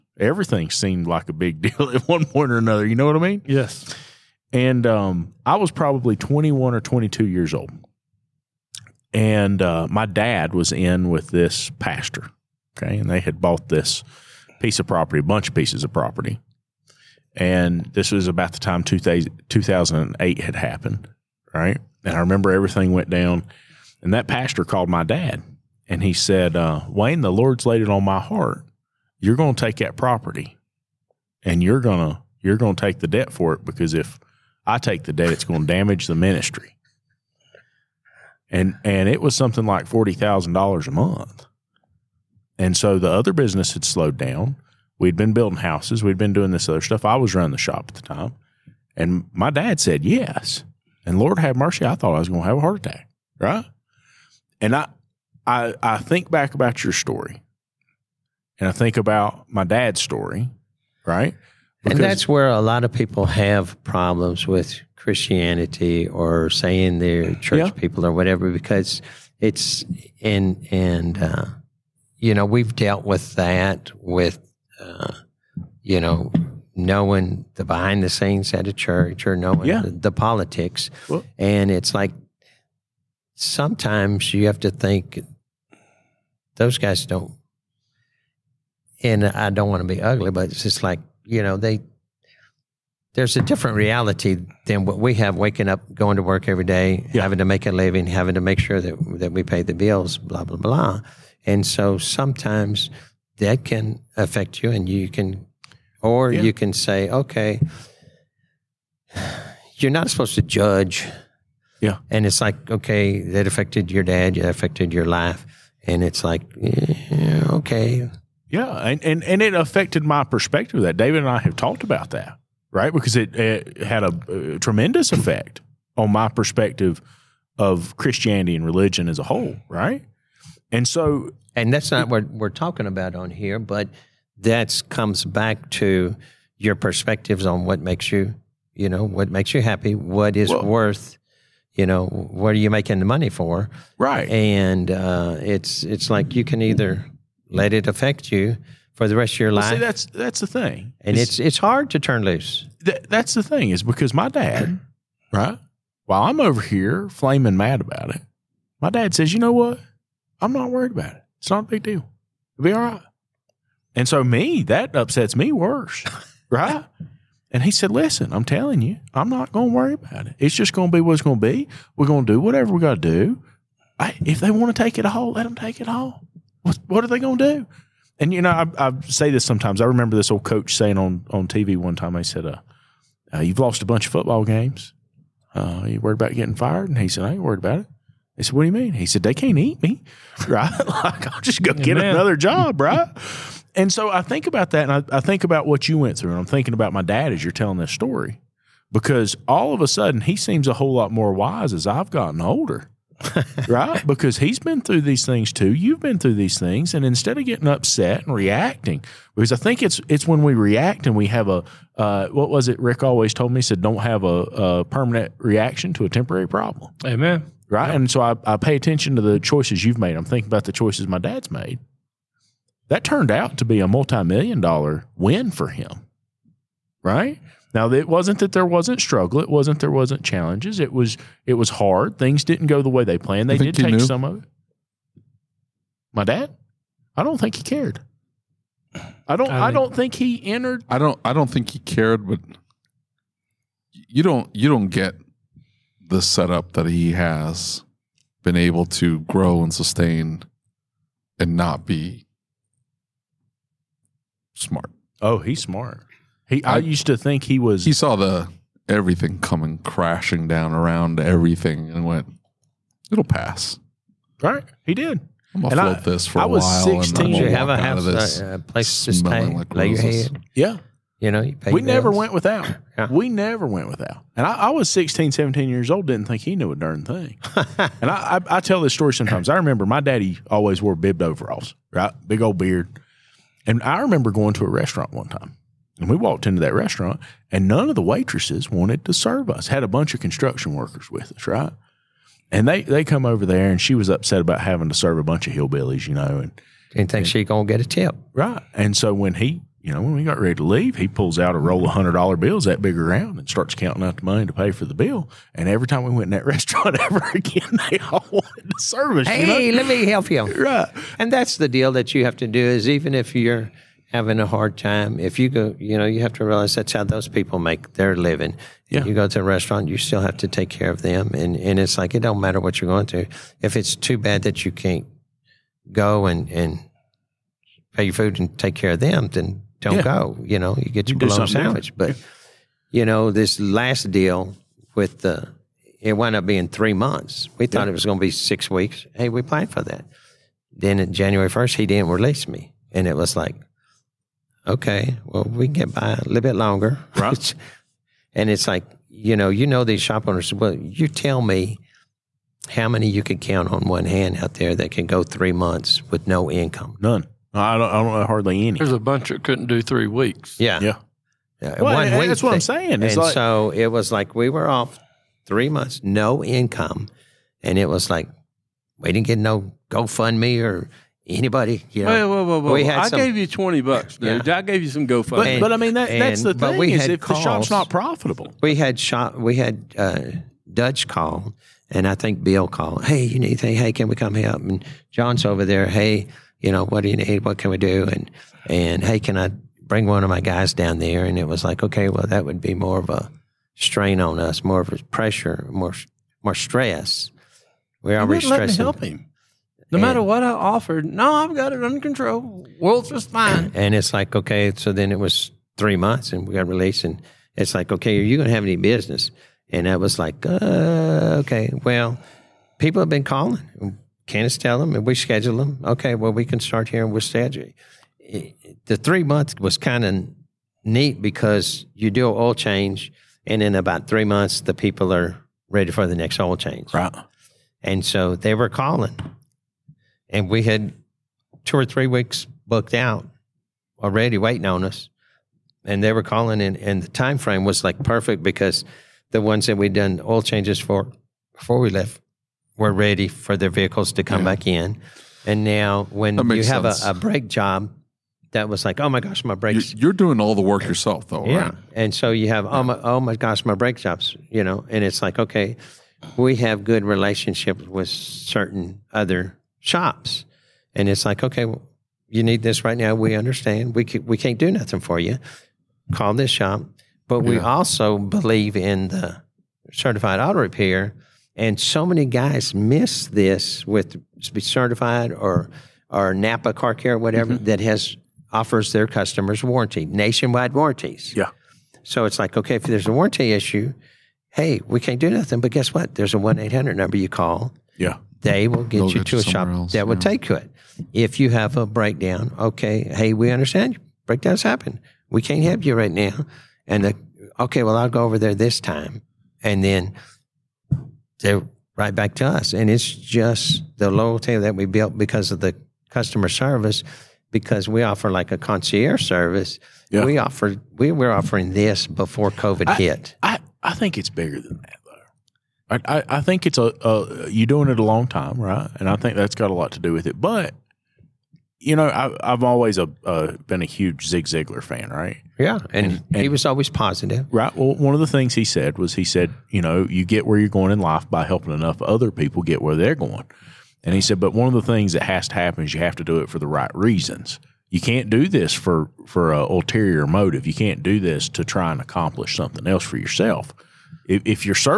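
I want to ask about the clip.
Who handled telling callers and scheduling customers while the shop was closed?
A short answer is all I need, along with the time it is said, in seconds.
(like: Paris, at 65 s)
Candace, at 414 s.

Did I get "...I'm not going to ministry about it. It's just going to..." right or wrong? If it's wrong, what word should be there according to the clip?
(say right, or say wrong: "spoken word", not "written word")
wrong: "worry", not "ministry".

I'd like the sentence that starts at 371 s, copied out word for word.
You know, whoa, whoa, whoa, We had I some, gave you 20 bucks, dude.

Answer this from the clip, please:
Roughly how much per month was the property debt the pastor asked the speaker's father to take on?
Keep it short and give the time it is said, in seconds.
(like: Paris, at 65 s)
$40,000, at 39 s.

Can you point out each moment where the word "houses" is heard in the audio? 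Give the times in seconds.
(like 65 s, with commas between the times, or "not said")
45 s, 267 s.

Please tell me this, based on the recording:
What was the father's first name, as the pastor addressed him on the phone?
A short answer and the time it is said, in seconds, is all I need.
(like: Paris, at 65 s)
Wayne, at 26 s.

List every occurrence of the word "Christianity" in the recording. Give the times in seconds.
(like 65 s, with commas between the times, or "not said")
64 s, 127 s.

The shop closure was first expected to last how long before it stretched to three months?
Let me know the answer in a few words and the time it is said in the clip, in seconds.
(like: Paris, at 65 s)
Six weeks, at 338 s.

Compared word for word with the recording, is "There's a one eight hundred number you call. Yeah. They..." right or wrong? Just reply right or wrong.
right.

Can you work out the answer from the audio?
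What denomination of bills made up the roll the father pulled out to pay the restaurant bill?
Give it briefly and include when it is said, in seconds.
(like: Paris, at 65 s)
Hundred dollar bills, at 301 s.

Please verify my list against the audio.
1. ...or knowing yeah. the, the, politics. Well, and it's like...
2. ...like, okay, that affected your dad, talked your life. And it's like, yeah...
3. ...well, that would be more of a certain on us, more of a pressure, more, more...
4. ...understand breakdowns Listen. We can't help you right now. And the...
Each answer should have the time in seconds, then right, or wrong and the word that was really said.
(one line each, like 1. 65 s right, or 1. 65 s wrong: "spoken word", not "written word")
1. 79 s right
2. 112 s wrong: "affected", not "talked"
3. 392 s wrong: "strain", not "certain"
4. 493 s wrong: "happen", not "Listen".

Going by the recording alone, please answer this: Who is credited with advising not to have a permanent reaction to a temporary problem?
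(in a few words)
Rick.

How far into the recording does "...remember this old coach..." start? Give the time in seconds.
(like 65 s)
179 s.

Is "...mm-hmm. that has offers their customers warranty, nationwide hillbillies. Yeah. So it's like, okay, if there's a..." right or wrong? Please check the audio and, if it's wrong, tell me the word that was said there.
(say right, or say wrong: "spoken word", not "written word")
wrong: "warranties", not "hillbillies".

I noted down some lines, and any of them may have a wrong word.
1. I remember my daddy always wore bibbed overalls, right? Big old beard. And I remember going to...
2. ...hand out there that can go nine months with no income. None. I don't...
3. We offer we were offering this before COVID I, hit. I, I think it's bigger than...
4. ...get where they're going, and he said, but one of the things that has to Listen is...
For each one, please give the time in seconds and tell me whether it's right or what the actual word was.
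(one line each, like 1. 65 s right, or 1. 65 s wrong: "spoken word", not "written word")
1. 279 s right
2. 354 s wrong: "three", not "nine"
3. 510 s right
4. 532 s wrong: "happen", not "Listen".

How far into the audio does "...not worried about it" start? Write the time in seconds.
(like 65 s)
160 s.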